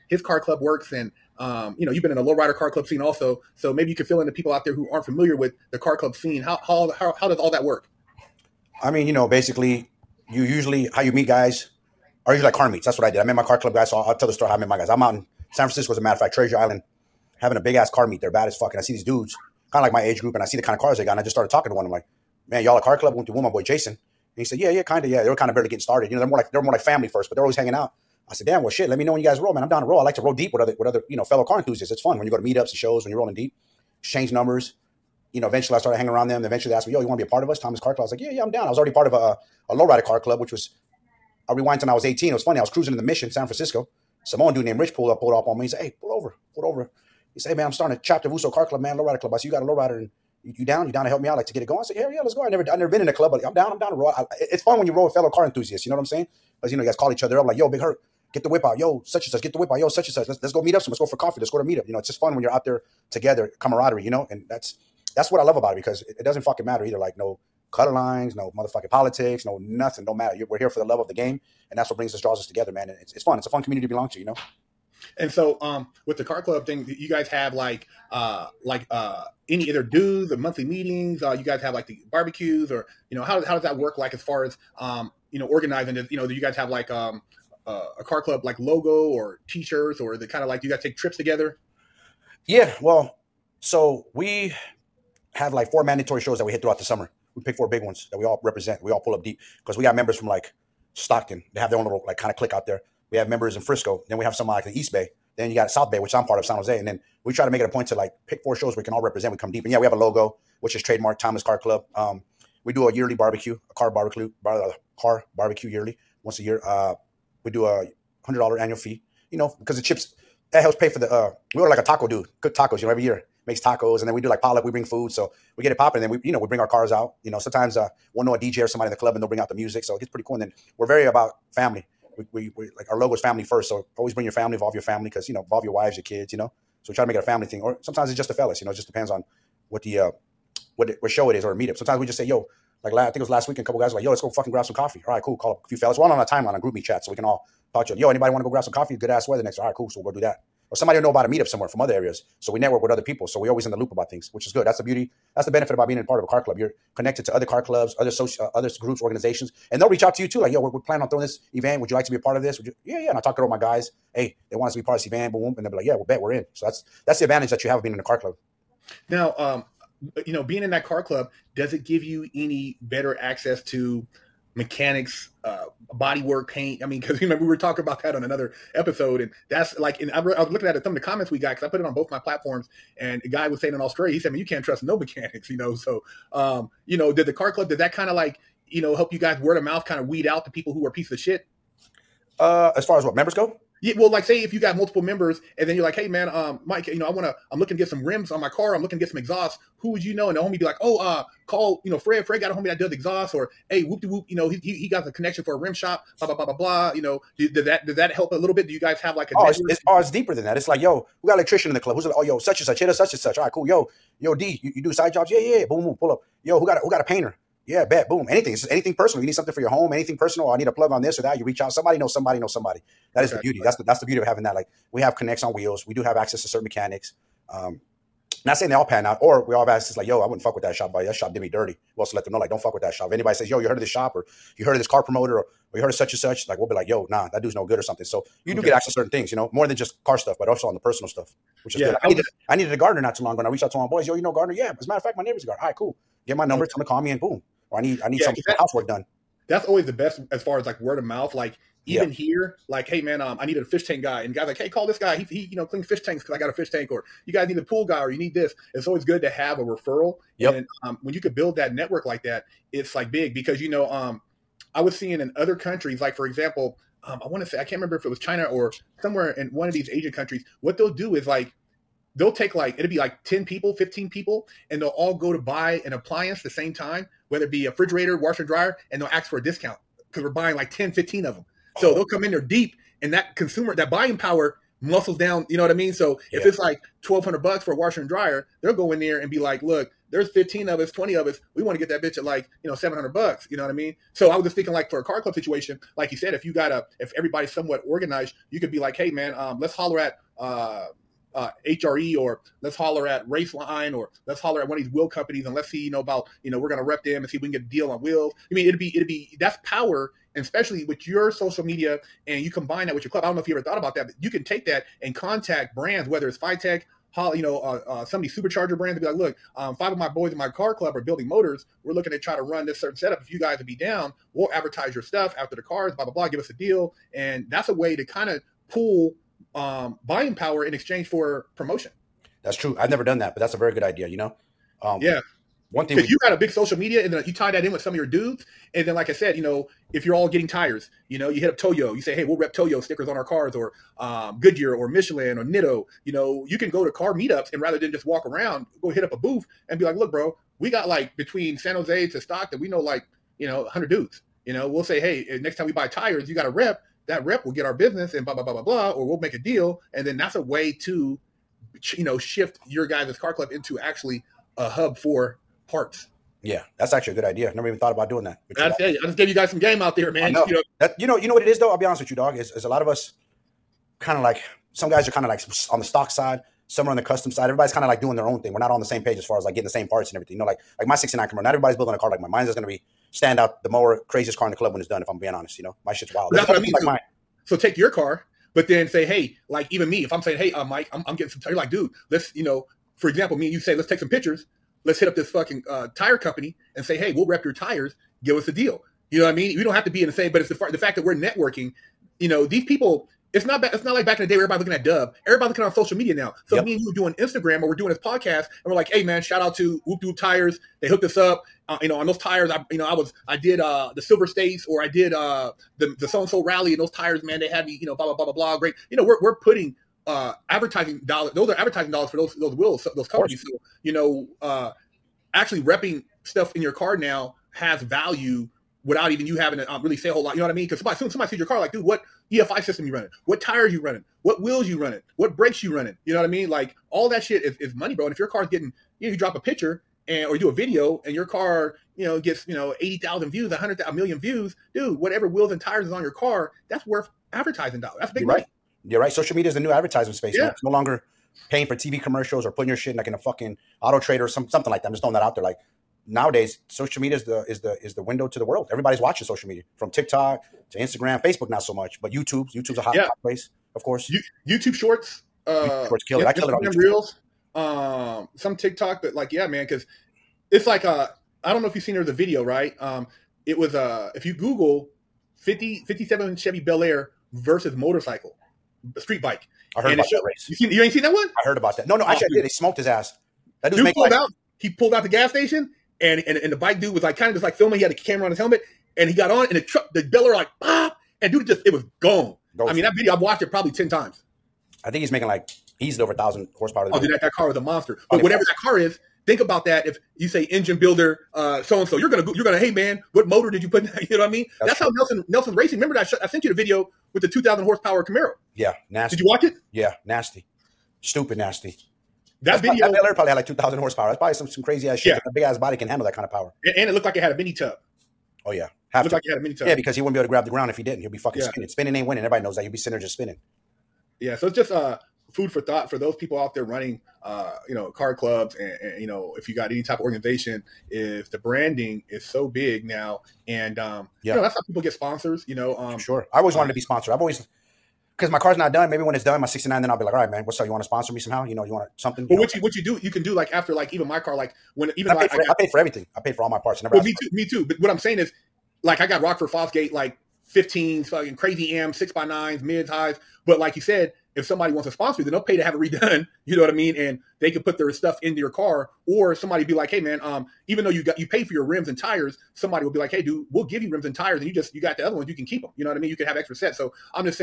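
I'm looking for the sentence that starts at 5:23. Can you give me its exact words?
If you guys would be down, we'll advertise your stuff after the cars, blah, blah, blah, give us a deal.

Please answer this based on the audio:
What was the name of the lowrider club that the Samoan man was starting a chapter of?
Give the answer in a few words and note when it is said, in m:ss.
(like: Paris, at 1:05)
Uso Car Club, at 0:48.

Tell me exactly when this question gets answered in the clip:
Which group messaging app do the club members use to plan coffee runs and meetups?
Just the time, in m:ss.
2:26.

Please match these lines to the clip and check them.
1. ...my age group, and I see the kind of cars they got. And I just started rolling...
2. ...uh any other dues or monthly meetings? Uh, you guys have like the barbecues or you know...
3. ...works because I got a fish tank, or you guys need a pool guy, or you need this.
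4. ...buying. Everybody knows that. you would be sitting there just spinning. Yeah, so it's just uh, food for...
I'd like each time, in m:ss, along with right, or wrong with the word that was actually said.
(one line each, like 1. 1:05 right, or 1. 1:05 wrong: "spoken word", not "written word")
1. 0:19 wrong: "talking", not "rolling"
2. 1:18 right
3. 4:16 wrong: "tanks", not "works"
4. 8:42 wrong: "winning", not "buying".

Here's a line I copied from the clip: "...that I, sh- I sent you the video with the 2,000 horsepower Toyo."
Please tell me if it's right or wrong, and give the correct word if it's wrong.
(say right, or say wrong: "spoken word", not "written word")
wrong: "Camaro", not "Toyo".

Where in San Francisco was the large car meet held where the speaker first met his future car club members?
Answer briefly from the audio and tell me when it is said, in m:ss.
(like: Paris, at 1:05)
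Treasure Island, at 0:16.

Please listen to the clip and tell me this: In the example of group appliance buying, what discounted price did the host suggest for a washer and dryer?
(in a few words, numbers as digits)
$700.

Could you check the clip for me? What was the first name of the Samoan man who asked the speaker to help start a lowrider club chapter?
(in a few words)
Rich.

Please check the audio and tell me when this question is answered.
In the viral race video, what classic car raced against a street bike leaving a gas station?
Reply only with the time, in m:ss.
7:55.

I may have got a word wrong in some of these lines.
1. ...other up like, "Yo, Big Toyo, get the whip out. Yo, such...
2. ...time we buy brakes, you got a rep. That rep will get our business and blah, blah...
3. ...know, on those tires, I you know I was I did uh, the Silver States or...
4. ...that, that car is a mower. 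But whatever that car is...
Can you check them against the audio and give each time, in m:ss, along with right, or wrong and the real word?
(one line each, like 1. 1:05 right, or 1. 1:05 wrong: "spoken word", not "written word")
1. 0:57 wrong: "Herc", not "Toyo"
2. 5:55 wrong: "tires", not "brakes"
3. 6:51 right
4. 8:17 wrong: "monster", not "mower".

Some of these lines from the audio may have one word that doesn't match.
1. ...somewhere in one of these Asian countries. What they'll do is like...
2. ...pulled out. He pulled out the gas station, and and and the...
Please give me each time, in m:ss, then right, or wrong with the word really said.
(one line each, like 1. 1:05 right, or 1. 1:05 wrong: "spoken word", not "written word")
1. 4:29 right
2. 8:03 right.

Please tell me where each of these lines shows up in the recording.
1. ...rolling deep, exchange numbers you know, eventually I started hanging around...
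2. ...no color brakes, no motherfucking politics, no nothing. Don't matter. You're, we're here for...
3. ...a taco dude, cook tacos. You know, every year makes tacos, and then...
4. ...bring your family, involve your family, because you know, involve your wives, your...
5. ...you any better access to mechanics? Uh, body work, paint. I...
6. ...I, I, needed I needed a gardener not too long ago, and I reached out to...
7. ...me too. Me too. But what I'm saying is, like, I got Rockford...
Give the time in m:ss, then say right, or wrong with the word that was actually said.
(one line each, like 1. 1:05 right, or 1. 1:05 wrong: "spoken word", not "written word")
1. 0:33 right
2. 1:07 wrong: "lines", not "brakes"
3. 2:01 right
4. 2:14 right
5. 2:52 right
6. 4:02 right
7. 9:07 right.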